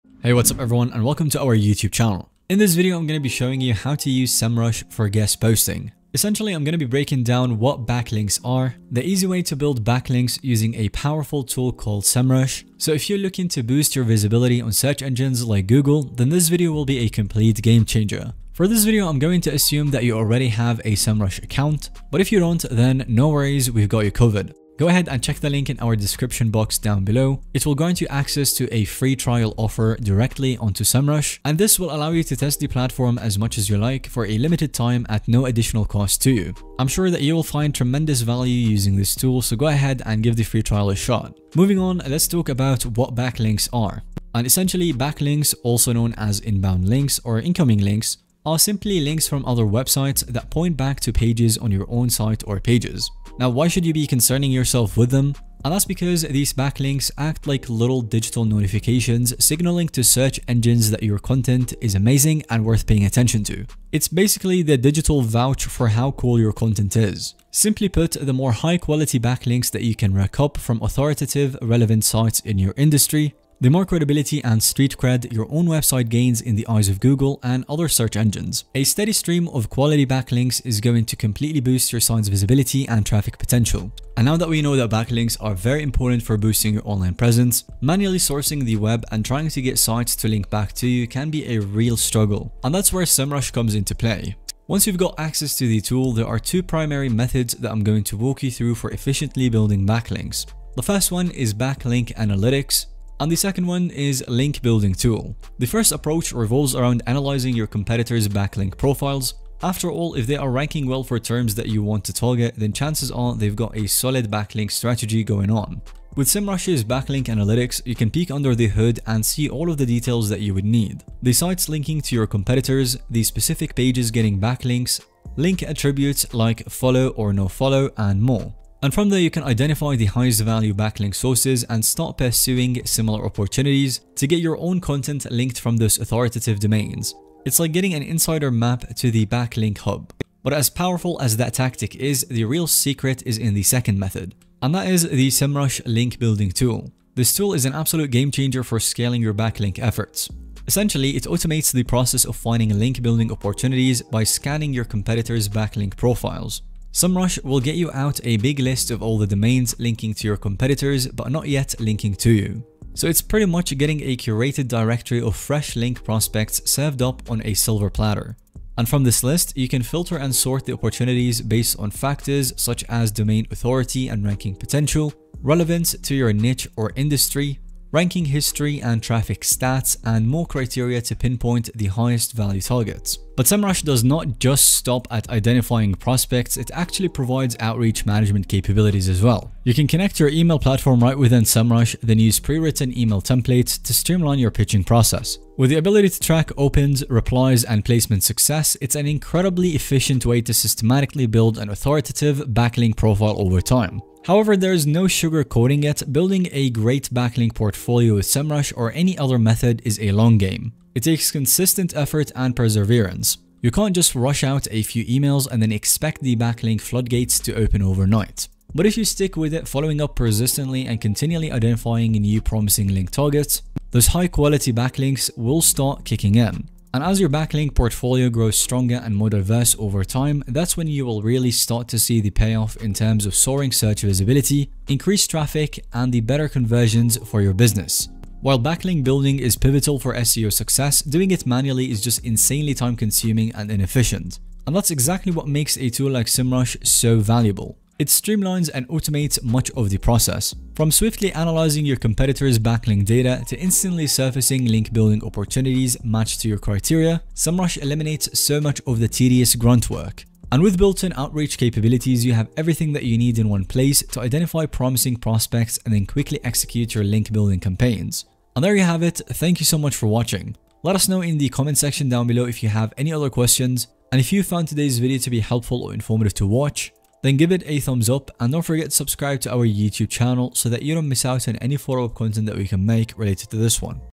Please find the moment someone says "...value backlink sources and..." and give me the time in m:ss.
2:10.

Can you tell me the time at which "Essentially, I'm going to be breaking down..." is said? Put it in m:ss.
0:06.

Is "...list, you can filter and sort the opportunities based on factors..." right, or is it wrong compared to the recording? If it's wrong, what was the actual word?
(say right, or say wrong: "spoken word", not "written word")
right.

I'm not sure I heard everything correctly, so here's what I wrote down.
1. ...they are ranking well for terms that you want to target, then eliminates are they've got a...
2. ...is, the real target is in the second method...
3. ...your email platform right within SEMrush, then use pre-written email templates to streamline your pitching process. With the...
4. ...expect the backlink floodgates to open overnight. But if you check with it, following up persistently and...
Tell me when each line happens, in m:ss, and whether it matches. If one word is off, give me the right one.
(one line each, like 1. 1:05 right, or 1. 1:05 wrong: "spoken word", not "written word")
1. 1:50 wrong: "chances", not "eliminates"
2. 2:21 wrong: "secret", not "target"
3. 3:10 right
4. 3:35 wrong: "stick", not "check".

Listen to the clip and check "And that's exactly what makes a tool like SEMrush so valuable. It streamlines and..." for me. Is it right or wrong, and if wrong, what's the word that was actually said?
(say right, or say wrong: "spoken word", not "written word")
right.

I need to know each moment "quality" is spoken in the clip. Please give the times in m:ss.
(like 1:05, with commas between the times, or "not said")
1:08, 1:19, 3:44.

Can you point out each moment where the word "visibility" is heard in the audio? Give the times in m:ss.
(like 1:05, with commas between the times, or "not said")
0:14, 1:22, 3:54.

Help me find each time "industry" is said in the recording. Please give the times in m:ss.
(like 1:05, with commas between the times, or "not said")
1:12, 2:56.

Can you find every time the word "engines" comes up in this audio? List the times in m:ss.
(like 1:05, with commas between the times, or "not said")
0:15, 1:00, 1:18.